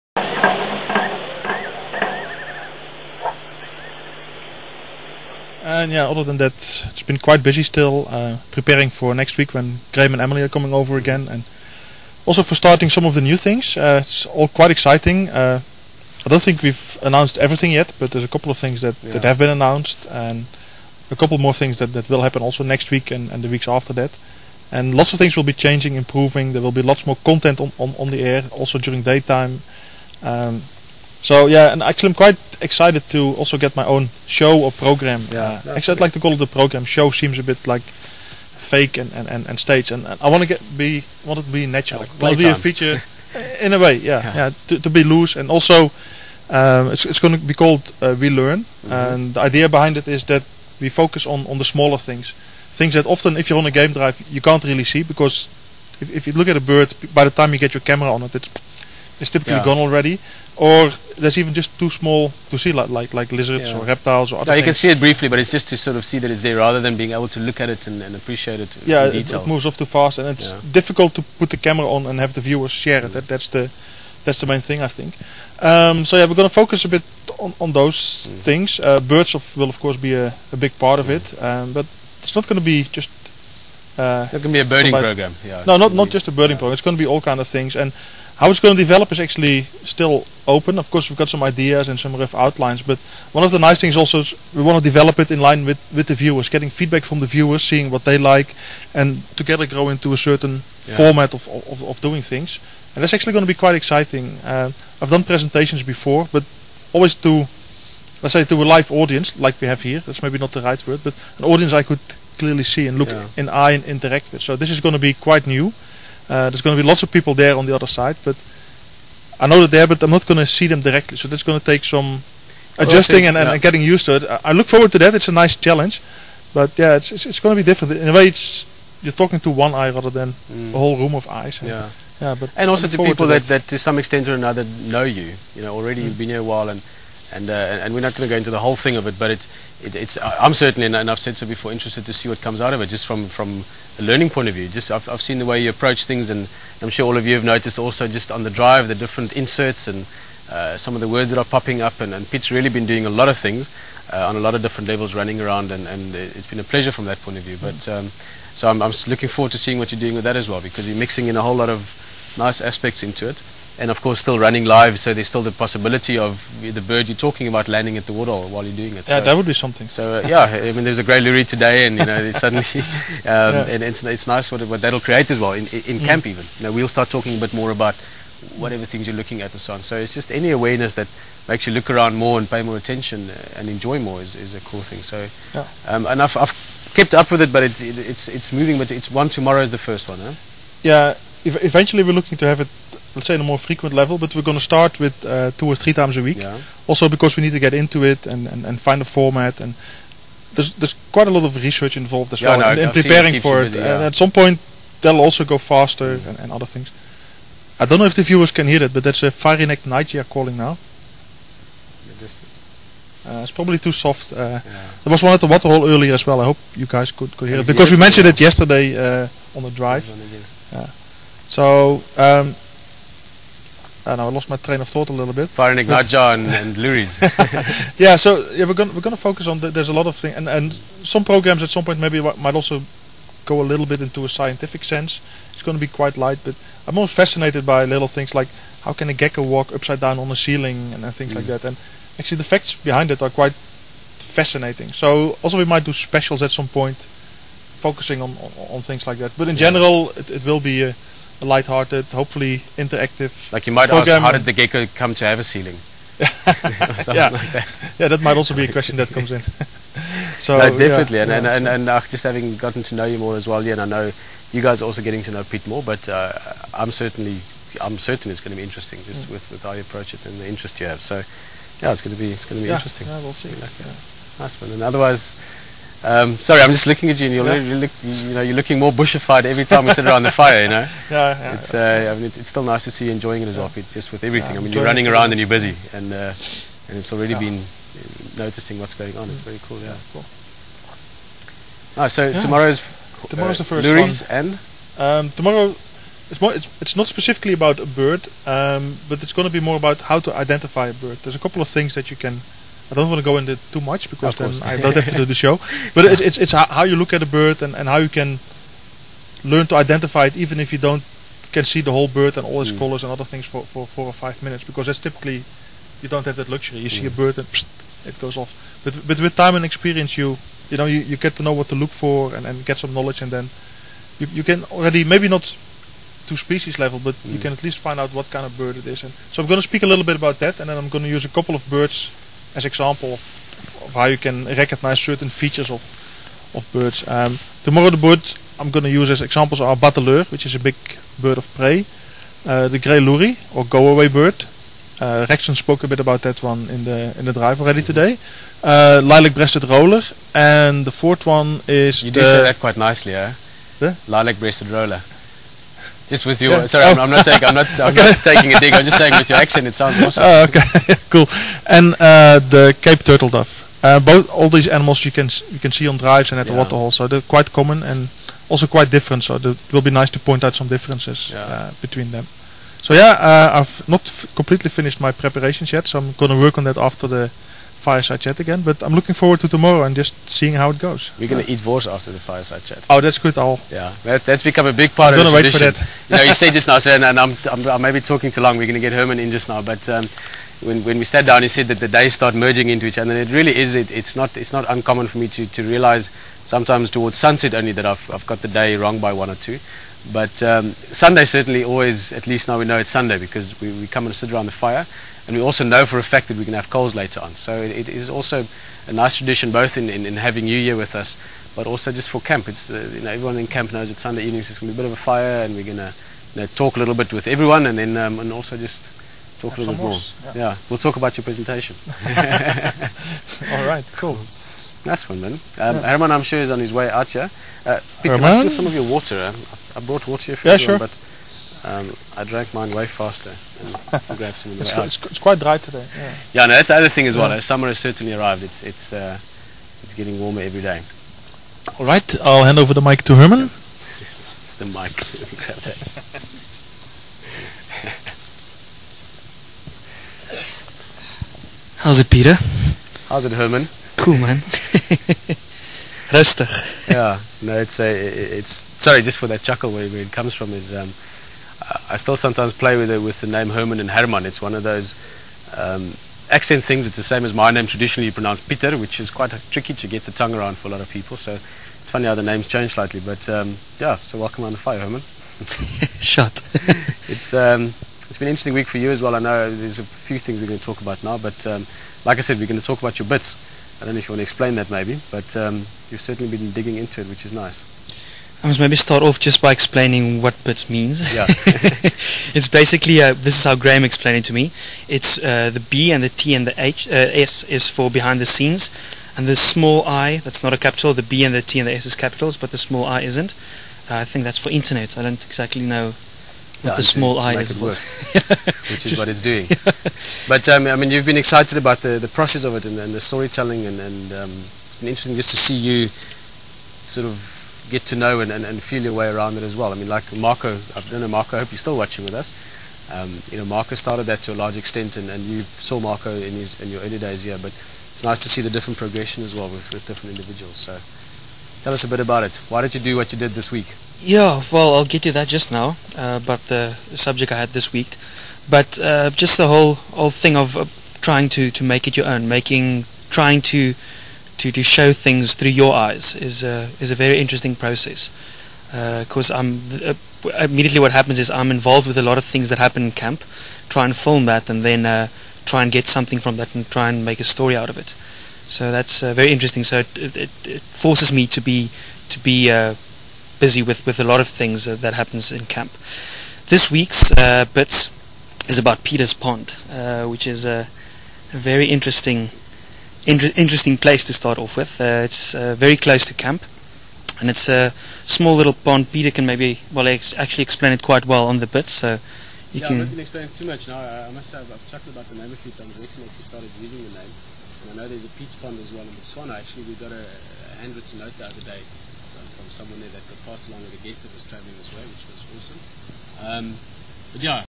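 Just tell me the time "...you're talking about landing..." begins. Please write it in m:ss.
2:47.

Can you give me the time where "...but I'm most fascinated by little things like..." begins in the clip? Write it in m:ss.
3:56.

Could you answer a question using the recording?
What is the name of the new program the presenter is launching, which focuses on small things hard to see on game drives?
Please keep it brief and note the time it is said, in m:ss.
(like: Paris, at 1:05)
We Learn, at 0:48.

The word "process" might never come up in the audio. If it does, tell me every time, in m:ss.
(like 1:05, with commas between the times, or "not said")
8:32, 9:07.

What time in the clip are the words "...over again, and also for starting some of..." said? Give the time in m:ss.
0:10.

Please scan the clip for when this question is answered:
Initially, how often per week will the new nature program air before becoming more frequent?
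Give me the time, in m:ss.
3:15.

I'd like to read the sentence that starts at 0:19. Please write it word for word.
that have been announced, and a couple more things that, that will happen also next week and, and the weeks after that.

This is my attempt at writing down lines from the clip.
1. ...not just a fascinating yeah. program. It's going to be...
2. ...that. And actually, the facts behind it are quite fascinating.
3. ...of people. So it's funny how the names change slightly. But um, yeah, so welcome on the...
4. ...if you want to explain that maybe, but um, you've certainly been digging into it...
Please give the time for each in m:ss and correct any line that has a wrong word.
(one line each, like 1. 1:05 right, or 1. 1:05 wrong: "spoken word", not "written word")
1. 1:25 wrong: "birding", not "fascinating"
2. 4:01 right
3. 7:50 right
4. 8:03 right.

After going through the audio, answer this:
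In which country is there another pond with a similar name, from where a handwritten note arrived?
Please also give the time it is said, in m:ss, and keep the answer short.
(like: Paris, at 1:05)
Botswana, at 9:48.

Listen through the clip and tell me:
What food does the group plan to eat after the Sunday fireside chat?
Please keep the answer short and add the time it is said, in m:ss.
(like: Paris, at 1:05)
wors, at 6:21.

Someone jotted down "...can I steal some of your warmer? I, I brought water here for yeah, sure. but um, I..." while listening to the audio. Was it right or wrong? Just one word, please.
wrong.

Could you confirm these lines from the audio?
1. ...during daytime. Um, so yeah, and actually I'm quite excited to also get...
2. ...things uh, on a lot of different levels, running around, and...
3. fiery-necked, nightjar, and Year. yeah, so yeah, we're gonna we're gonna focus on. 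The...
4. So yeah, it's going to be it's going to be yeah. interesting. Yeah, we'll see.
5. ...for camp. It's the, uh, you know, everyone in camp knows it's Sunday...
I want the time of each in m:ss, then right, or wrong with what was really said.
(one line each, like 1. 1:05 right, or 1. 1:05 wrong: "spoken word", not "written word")
1. 0:28 right
2. 2:33 right
3. 3:45 wrong: "Luries", not "Year"
4. 4:31 right
5. 6:52 right.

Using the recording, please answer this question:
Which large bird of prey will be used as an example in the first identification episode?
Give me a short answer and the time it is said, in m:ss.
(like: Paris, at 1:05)
bateleur, at 5:39.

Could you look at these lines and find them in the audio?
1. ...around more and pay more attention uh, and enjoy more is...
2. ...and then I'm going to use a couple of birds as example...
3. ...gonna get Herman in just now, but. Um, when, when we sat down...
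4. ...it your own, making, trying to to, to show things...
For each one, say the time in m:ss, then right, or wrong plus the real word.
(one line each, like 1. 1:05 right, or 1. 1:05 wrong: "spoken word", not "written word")
1. 3:01 right
2. 5:30 right
3. 6:28 right
4. 9:01 right.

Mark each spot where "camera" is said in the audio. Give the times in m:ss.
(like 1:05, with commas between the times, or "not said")
0:57, 1:11.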